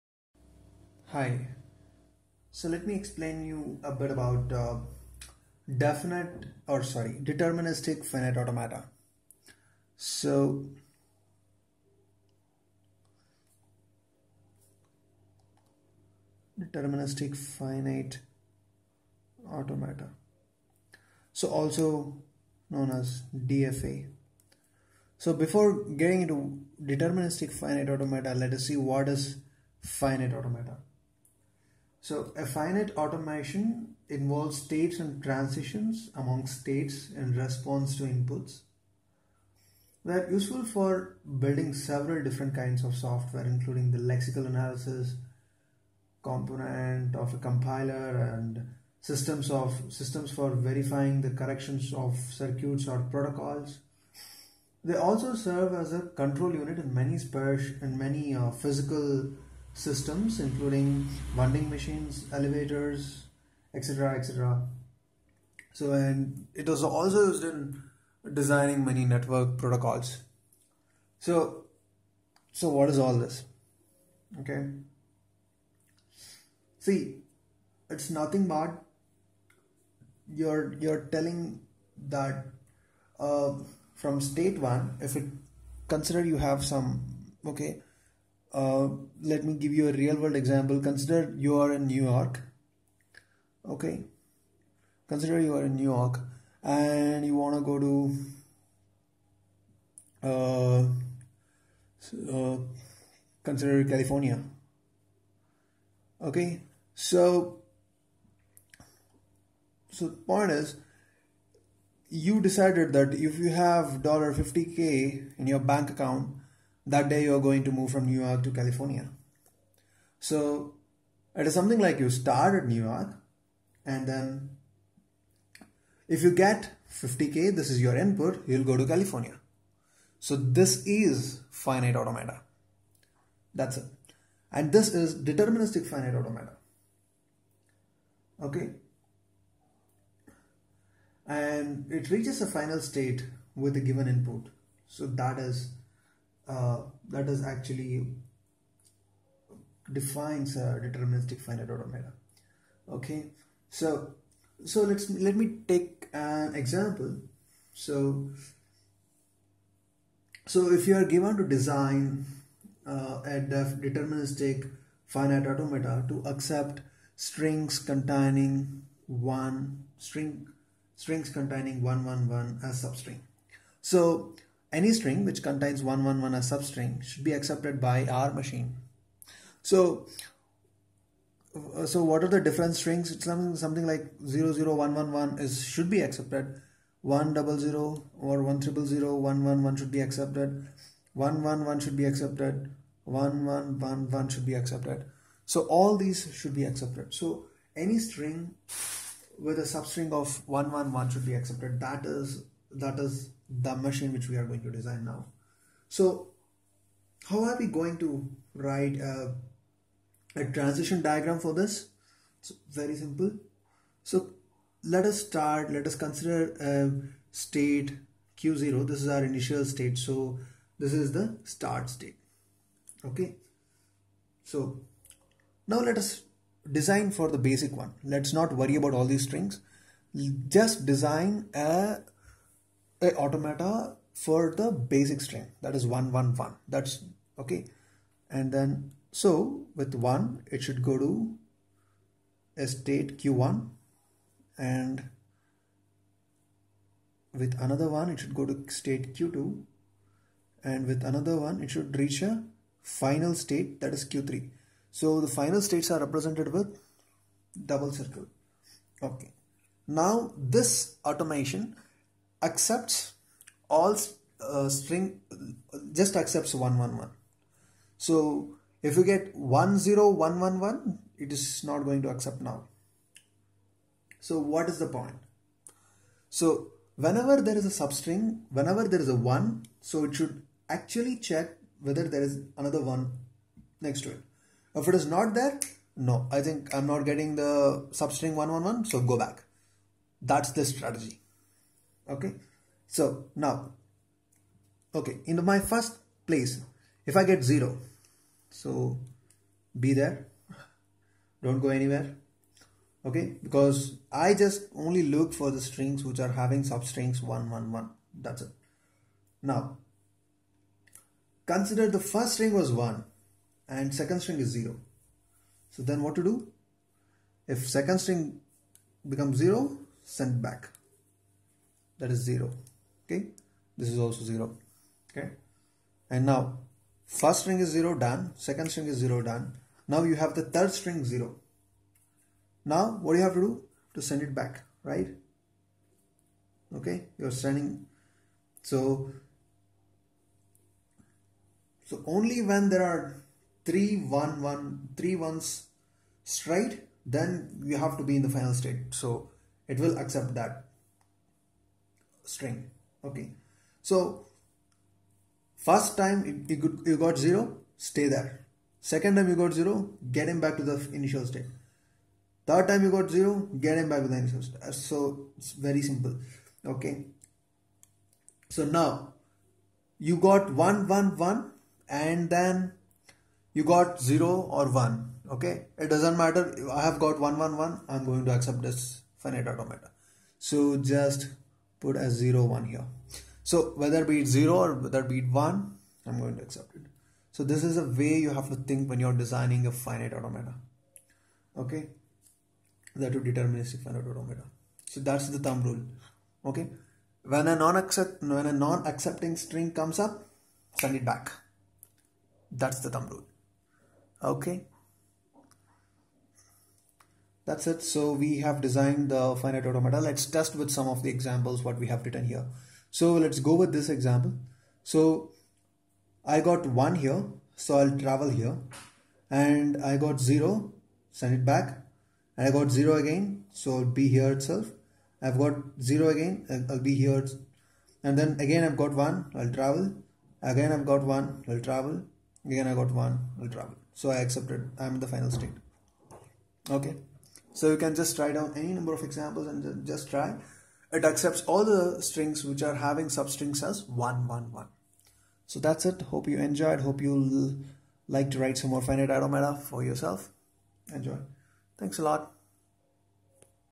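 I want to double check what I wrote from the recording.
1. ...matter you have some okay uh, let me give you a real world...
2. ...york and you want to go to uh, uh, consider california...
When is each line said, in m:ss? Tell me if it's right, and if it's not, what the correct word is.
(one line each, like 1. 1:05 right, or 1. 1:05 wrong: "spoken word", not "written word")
1. 1:25 wrong: "consider", not "matter"
2. 1:35 right.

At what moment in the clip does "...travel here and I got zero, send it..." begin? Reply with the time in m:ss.
6:58.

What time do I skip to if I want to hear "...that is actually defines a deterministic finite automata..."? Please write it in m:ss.
2:27.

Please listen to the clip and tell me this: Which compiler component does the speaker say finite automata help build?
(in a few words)
lexical analysis.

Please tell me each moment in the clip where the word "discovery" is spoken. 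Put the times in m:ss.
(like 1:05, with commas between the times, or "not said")
not said.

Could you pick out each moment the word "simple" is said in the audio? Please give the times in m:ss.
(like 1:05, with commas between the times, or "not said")
3:32, 6:05.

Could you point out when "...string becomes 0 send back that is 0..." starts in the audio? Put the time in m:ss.
5:17.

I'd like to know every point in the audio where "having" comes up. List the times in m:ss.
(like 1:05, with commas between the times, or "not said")
5:06, 7:22.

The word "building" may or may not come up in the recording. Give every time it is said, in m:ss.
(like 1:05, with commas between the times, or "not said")
0:41.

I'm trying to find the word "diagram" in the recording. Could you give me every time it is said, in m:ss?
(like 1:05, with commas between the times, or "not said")
3:31.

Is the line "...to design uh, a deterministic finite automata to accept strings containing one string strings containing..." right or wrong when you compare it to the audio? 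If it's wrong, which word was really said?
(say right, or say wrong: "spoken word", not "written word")
right.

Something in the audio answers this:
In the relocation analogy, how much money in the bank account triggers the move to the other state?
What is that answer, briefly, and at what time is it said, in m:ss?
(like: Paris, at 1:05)
$50k, at 1:54.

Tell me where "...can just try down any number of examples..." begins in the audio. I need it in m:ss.
7:17.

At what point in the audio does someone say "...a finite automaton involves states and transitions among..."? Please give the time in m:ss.
0:32.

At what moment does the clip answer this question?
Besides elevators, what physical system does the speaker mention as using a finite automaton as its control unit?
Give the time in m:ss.
1:01.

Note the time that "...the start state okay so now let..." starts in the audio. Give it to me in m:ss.
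3:41.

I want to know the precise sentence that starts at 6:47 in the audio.
So we have designed the finite automata.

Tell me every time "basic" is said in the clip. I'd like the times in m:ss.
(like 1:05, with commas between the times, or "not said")
3:47, 3:54.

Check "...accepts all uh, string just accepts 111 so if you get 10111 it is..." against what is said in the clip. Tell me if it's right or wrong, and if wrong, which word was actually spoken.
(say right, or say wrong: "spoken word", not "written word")
right.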